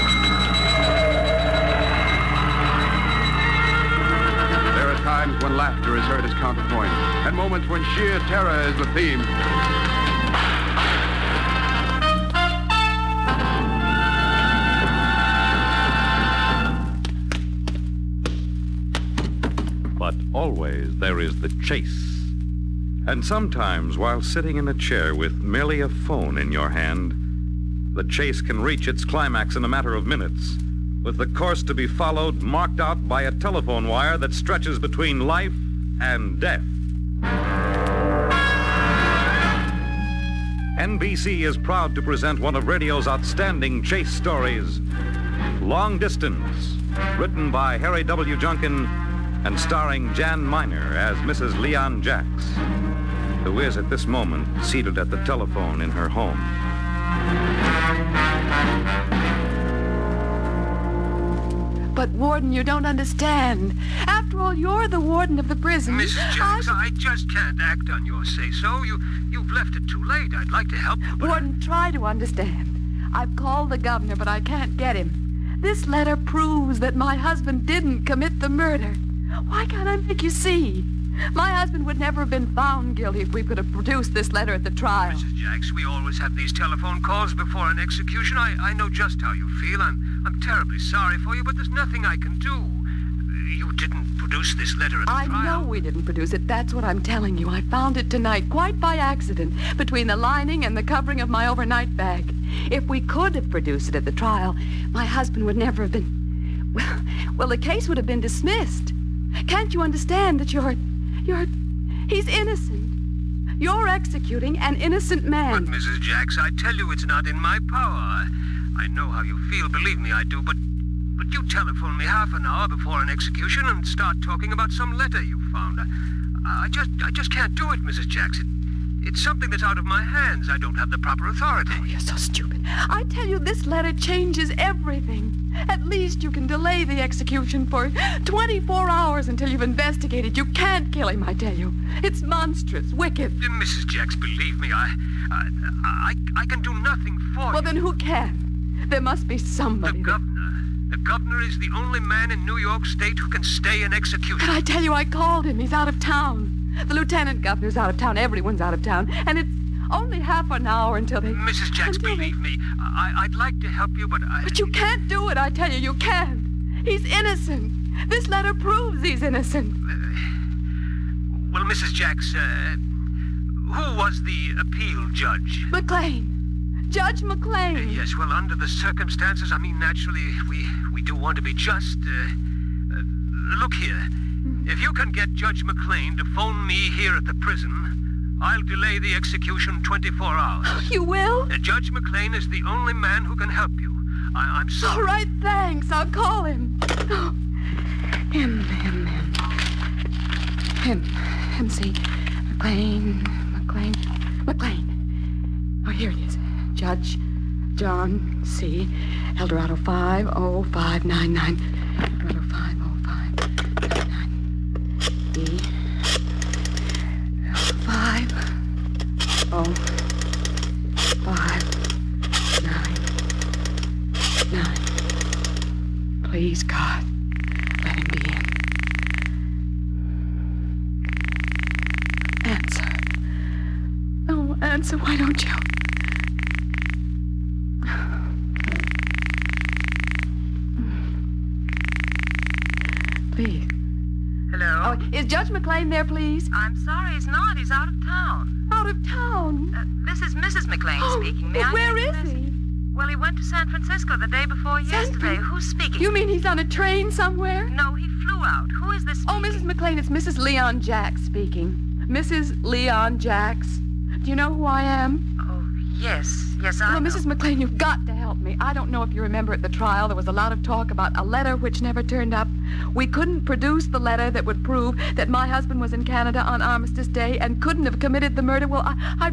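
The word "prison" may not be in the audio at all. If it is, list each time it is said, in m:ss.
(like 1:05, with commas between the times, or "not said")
1:05, 3:07.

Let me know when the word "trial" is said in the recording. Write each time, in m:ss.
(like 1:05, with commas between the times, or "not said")
1:24, 1:35, 1:44, 4:29.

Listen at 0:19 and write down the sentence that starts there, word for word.
But always there is the chase.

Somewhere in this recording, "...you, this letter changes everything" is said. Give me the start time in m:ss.
2:13.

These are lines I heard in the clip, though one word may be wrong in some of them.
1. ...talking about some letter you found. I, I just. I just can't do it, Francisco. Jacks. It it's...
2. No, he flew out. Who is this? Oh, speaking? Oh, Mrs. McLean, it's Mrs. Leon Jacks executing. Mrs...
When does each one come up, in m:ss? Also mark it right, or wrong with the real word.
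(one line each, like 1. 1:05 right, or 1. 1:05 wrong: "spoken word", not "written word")
1. 2:04 wrong: "Mrs", not "Francisco"
2. 4:17 wrong: "speaking", not "executing".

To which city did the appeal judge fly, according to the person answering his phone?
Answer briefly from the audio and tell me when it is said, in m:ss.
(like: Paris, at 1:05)
San Francisco, at 4:13.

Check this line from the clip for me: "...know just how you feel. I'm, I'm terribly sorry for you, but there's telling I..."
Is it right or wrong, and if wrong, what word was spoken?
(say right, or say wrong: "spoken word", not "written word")
wrong: "nothing", not "telling".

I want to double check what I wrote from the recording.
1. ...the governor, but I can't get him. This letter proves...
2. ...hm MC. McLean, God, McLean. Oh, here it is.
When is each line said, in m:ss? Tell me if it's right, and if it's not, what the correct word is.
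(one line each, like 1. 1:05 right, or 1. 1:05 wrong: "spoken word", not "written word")
1. 1:13 right
2. 3:20 wrong: "McLean", not "God".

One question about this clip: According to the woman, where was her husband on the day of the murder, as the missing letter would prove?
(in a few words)
Canada.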